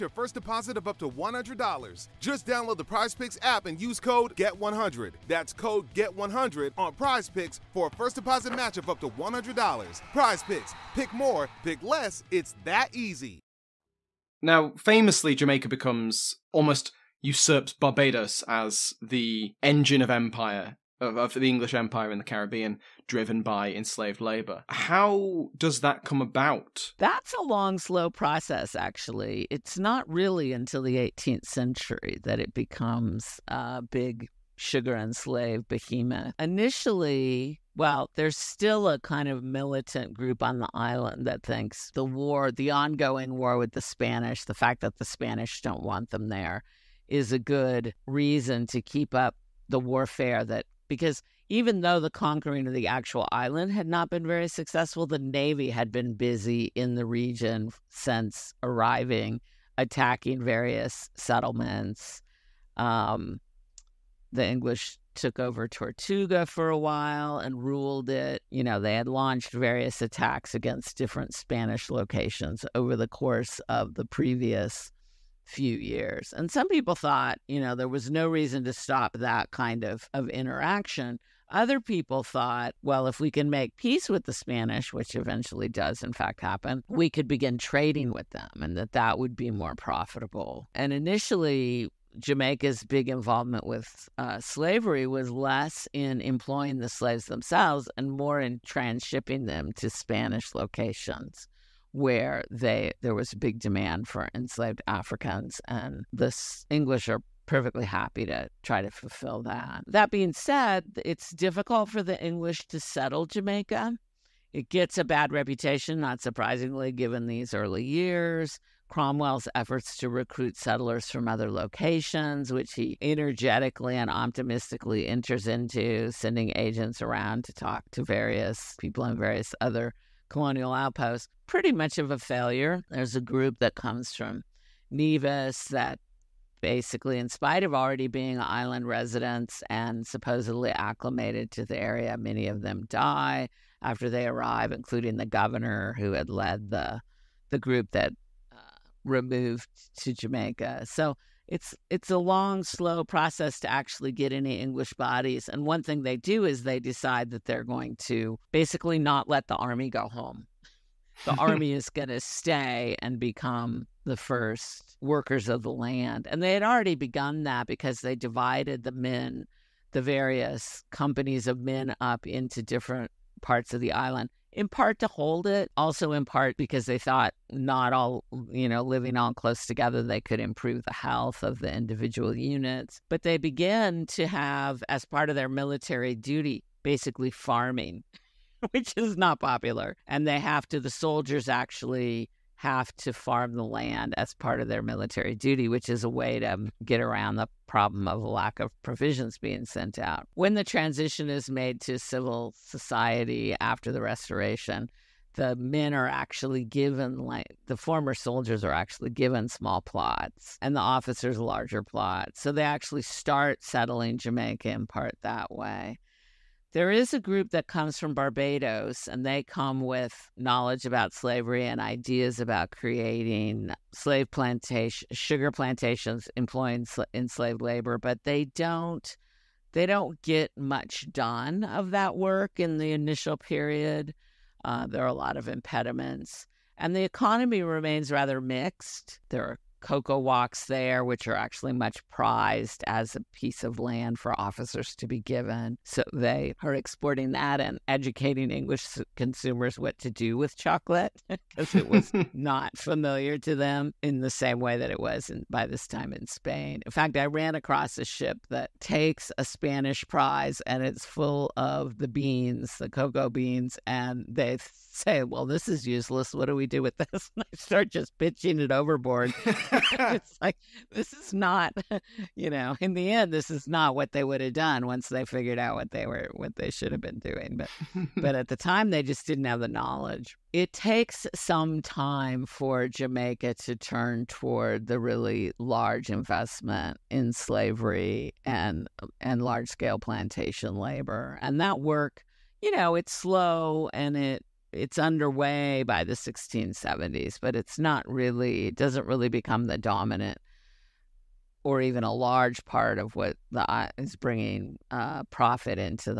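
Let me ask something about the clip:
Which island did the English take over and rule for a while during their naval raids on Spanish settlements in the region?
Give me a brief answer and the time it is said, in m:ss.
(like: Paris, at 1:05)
Tortuga, at 1:05.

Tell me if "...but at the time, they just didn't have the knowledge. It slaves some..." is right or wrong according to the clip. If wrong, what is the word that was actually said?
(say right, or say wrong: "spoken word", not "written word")
wrong: "takes", not "slaves".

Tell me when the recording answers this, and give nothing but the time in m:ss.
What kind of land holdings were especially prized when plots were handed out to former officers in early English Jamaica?
3:59.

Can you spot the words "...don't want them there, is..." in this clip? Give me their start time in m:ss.
0:45.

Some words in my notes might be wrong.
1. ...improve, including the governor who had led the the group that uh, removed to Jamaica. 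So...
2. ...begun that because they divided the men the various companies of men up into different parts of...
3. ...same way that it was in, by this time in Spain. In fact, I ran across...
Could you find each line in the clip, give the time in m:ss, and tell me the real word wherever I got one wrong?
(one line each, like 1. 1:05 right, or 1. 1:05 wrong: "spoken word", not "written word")
1. 2:24 wrong: "arrive", not "improve"
2. 2:46 right
3. 4:14 right.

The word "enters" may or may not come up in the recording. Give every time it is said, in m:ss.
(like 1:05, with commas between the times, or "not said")
2:05.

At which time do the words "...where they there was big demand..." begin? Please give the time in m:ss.
1:41.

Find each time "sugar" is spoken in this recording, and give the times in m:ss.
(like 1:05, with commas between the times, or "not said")
0:34, 3:45.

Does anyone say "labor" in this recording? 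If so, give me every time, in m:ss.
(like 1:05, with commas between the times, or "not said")
0:24, 3:47, 4:50.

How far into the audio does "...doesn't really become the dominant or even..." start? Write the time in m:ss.
4:58.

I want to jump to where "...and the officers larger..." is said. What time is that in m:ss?
3:30.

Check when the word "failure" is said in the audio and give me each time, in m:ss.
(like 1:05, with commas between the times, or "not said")
2:12.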